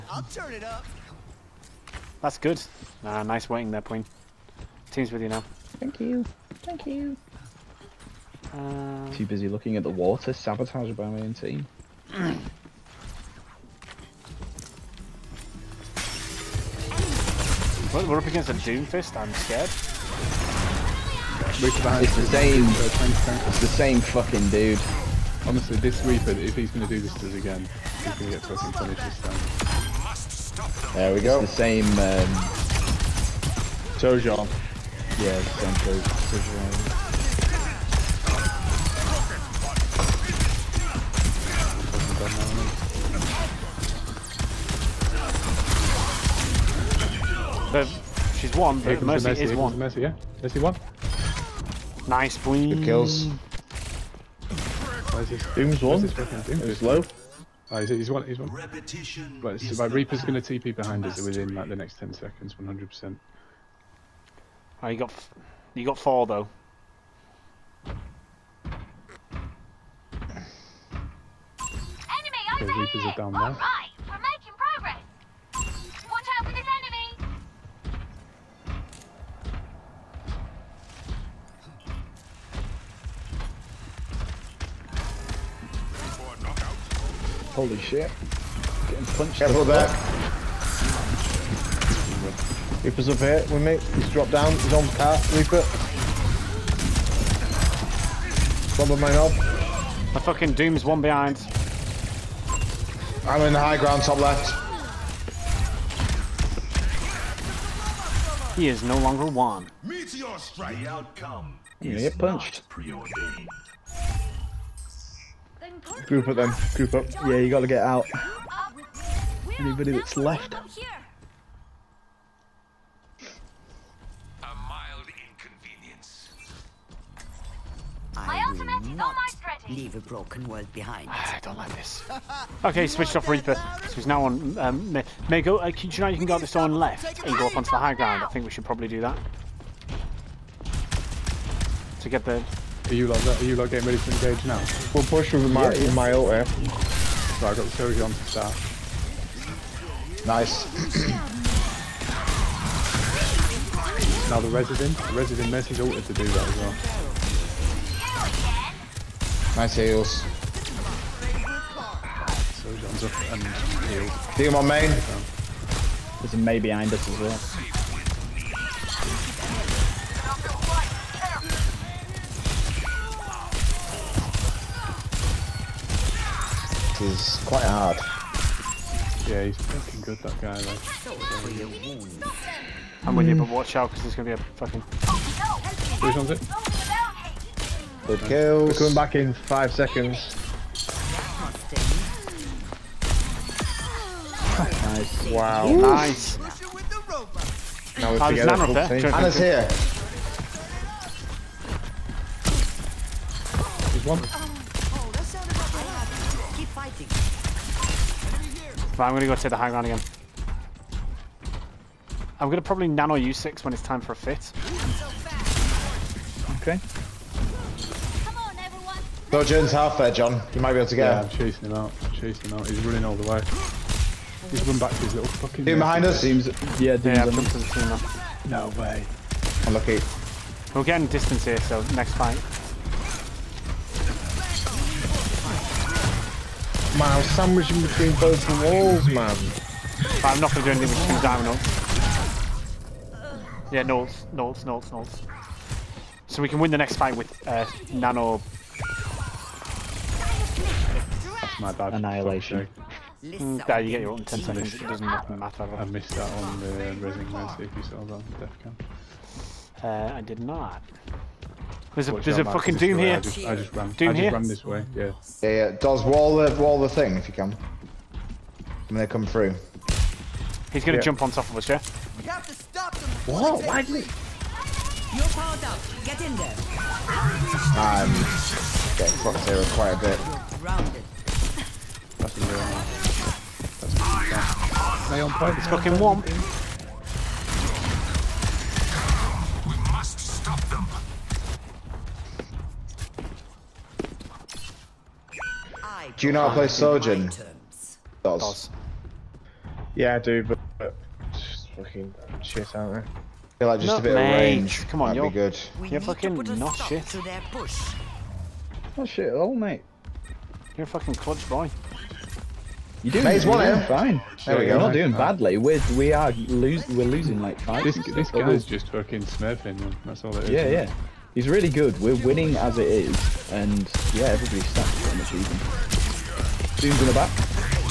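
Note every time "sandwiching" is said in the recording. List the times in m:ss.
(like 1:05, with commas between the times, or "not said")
3:57.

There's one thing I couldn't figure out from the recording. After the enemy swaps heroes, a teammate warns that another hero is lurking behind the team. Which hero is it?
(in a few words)
Mei.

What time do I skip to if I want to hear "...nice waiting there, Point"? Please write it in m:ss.
0:03.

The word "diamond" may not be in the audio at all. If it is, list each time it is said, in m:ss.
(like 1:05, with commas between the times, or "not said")
4:01.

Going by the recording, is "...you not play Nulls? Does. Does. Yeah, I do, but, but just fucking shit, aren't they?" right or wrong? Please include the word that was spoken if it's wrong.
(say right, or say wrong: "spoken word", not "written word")
wrong: "Sojourn", not "Nulls".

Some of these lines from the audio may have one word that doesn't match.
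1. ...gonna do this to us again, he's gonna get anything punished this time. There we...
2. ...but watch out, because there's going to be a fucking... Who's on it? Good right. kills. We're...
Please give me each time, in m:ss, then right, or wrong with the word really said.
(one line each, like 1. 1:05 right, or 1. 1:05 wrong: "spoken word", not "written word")
1. 0:26 wrong: "fucking", not "anything"
2. 3:03 right.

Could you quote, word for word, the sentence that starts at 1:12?
Enemy, okay, Reapers are down there.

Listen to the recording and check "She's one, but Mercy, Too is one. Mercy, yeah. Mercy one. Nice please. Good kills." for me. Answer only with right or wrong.
wrong.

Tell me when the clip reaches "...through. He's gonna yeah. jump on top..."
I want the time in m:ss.
4:29.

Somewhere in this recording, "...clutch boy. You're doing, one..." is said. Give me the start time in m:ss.
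5:11.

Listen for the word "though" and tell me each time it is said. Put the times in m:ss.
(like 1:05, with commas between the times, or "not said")
1:06, 3:00.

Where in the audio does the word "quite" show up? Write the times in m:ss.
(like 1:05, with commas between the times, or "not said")
2:57, 4:39.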